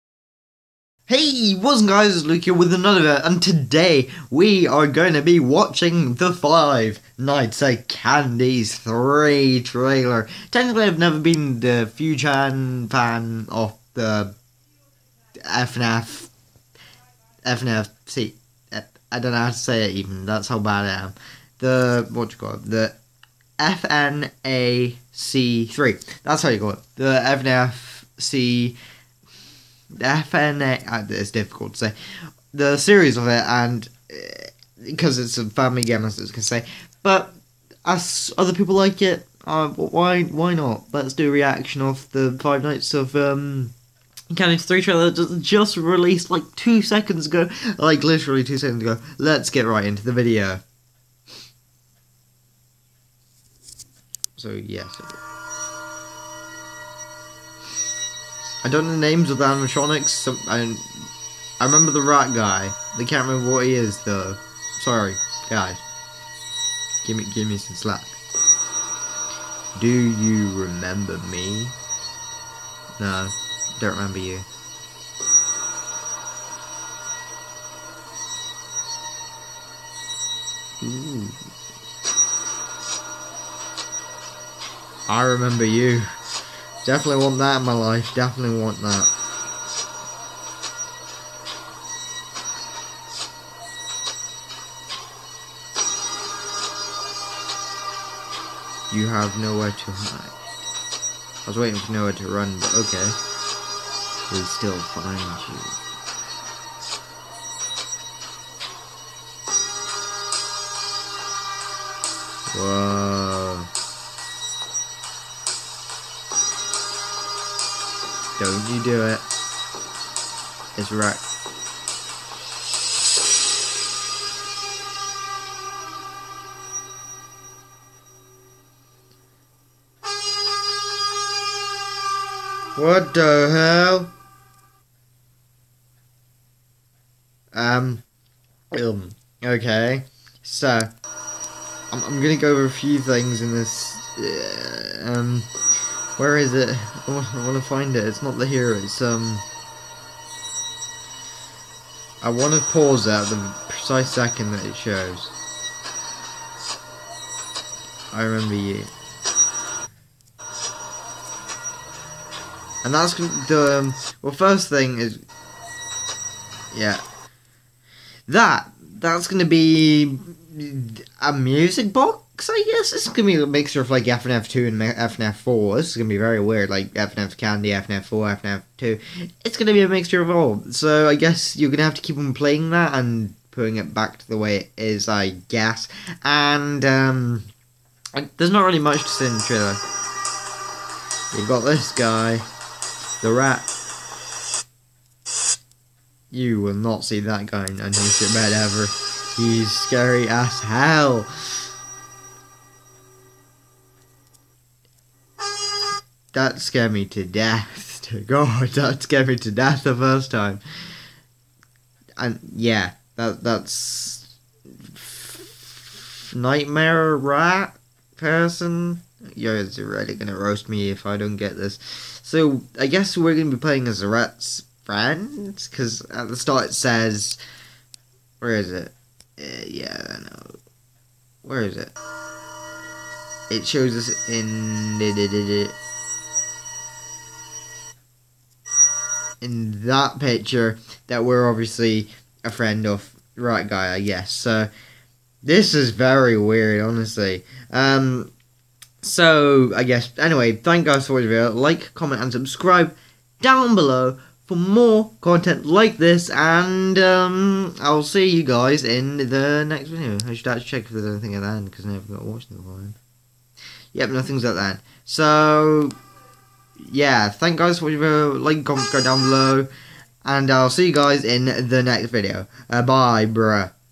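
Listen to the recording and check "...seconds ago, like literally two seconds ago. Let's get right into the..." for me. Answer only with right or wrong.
right.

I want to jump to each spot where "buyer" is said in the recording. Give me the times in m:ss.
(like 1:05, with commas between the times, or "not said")
not said.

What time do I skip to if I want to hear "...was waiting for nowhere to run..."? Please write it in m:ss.
1:41.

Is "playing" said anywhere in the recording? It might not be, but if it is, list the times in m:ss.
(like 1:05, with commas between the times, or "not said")
3:02, 3:43.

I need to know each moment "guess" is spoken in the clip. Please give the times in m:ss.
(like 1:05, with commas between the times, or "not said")
2:52, 3:01, 3:05, 3:42, 4:04, 4:09.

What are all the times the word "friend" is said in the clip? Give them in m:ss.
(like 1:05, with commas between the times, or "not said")
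3:44, 4:02.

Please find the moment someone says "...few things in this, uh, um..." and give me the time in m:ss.
2:22.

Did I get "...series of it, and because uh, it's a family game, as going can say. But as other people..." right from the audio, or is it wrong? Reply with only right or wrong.
right.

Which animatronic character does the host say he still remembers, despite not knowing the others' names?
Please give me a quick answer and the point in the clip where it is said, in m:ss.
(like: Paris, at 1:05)
The rat guy, at 1:01.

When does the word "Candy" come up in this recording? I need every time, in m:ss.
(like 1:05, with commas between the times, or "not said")
0:07, 0:44, 2:57.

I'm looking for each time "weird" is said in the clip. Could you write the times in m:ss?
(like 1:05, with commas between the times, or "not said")
2:56, 4:06.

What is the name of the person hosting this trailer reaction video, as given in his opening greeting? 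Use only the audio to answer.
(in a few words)
Luke.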